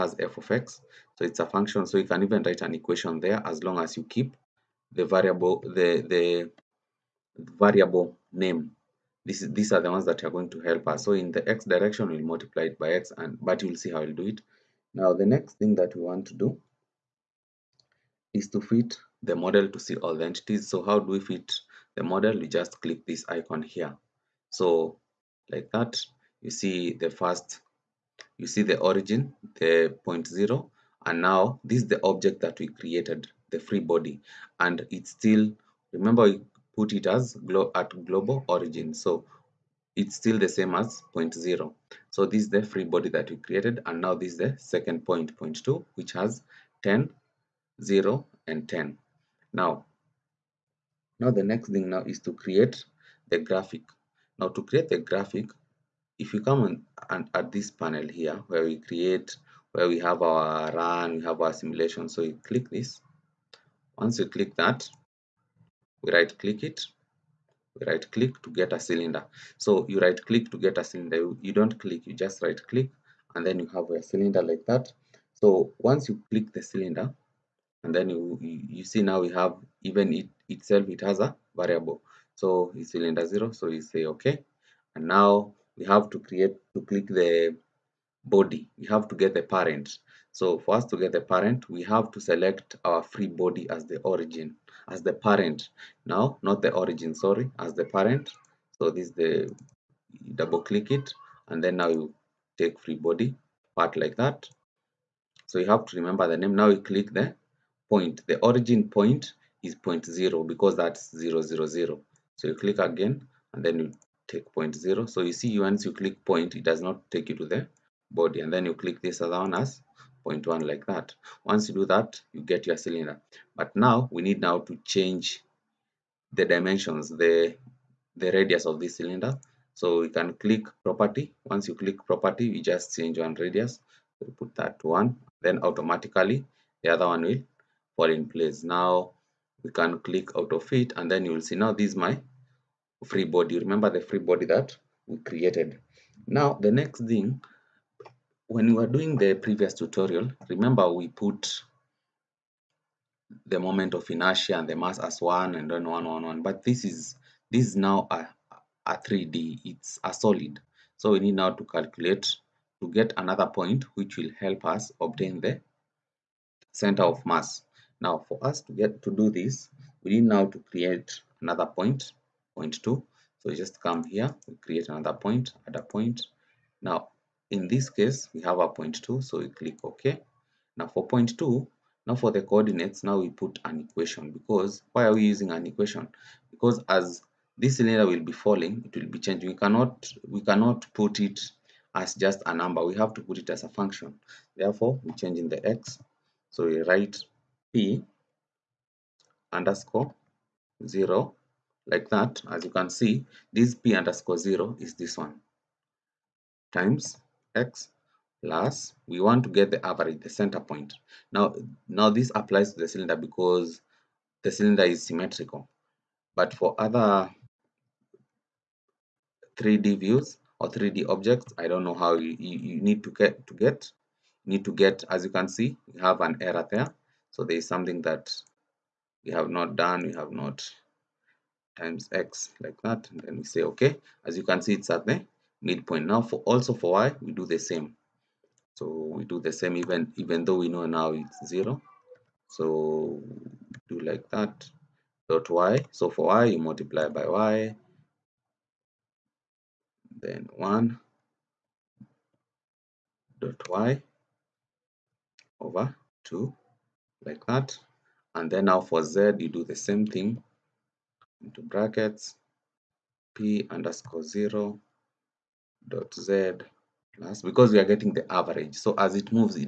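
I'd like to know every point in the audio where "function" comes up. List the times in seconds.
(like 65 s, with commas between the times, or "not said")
1 s, 193 s.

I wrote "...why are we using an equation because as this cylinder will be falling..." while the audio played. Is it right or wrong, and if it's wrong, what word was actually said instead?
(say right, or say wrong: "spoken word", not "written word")
right.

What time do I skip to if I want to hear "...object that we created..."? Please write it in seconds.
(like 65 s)
32 s.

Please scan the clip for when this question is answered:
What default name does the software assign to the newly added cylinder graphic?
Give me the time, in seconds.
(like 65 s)
82 s.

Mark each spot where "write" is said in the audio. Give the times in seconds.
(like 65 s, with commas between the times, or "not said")
2 s, 196 s.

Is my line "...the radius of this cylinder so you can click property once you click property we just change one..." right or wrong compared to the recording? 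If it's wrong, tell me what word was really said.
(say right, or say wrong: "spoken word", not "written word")
right.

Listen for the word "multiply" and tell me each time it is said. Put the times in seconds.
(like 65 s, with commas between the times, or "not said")
12 s, 246 s.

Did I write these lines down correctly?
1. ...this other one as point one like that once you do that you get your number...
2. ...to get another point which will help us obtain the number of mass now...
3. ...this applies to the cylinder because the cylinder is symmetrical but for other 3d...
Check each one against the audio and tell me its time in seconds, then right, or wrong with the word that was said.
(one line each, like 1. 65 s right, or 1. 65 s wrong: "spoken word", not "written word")
1. 119 s wrong: "cylinder", not "number"
2. 162 s wrong: "center", not "number"
3. 212 s right.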